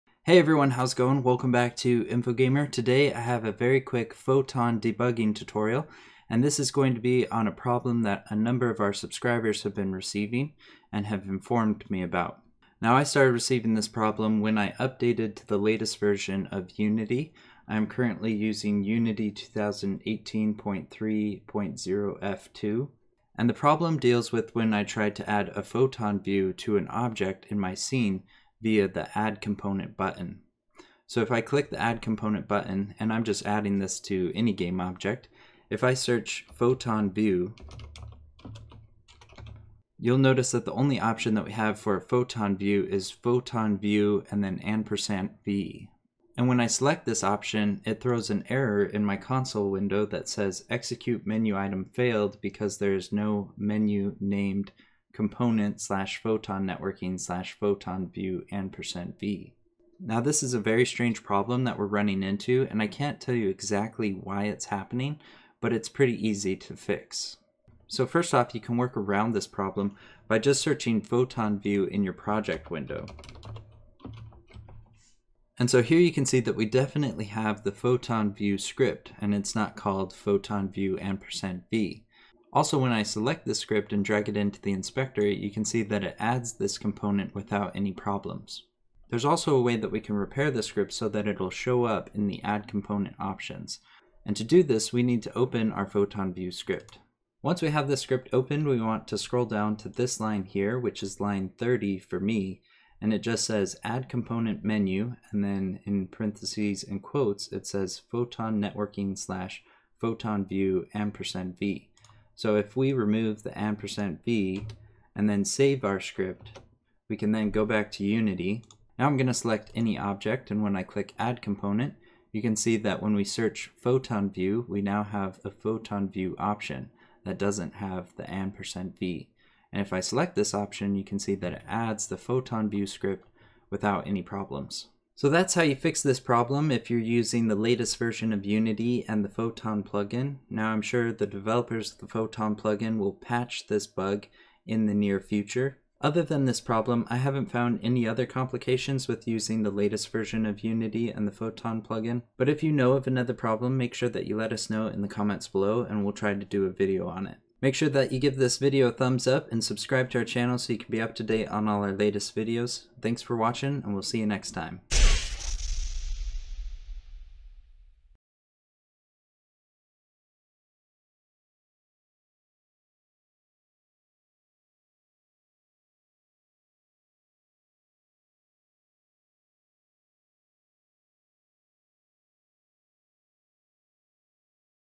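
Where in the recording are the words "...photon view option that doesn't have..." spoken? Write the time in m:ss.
2:05.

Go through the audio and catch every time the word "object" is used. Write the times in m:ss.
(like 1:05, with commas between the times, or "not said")
0:26, 0:34, 1:59.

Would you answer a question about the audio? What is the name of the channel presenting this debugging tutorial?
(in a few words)
InfoGamer.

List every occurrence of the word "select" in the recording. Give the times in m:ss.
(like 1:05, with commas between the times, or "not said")
0:46, 1:23, 1:59, 2:09.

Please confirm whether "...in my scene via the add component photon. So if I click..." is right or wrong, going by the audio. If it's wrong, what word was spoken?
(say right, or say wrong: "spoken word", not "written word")
wrong: "button", not "photon".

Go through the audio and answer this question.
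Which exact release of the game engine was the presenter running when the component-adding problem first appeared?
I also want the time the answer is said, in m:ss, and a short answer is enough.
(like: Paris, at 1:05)
2018.3.0F2, at 0:19.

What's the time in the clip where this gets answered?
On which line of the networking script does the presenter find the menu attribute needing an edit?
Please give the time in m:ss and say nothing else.
1:41.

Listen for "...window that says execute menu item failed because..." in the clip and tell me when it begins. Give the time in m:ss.
0:49.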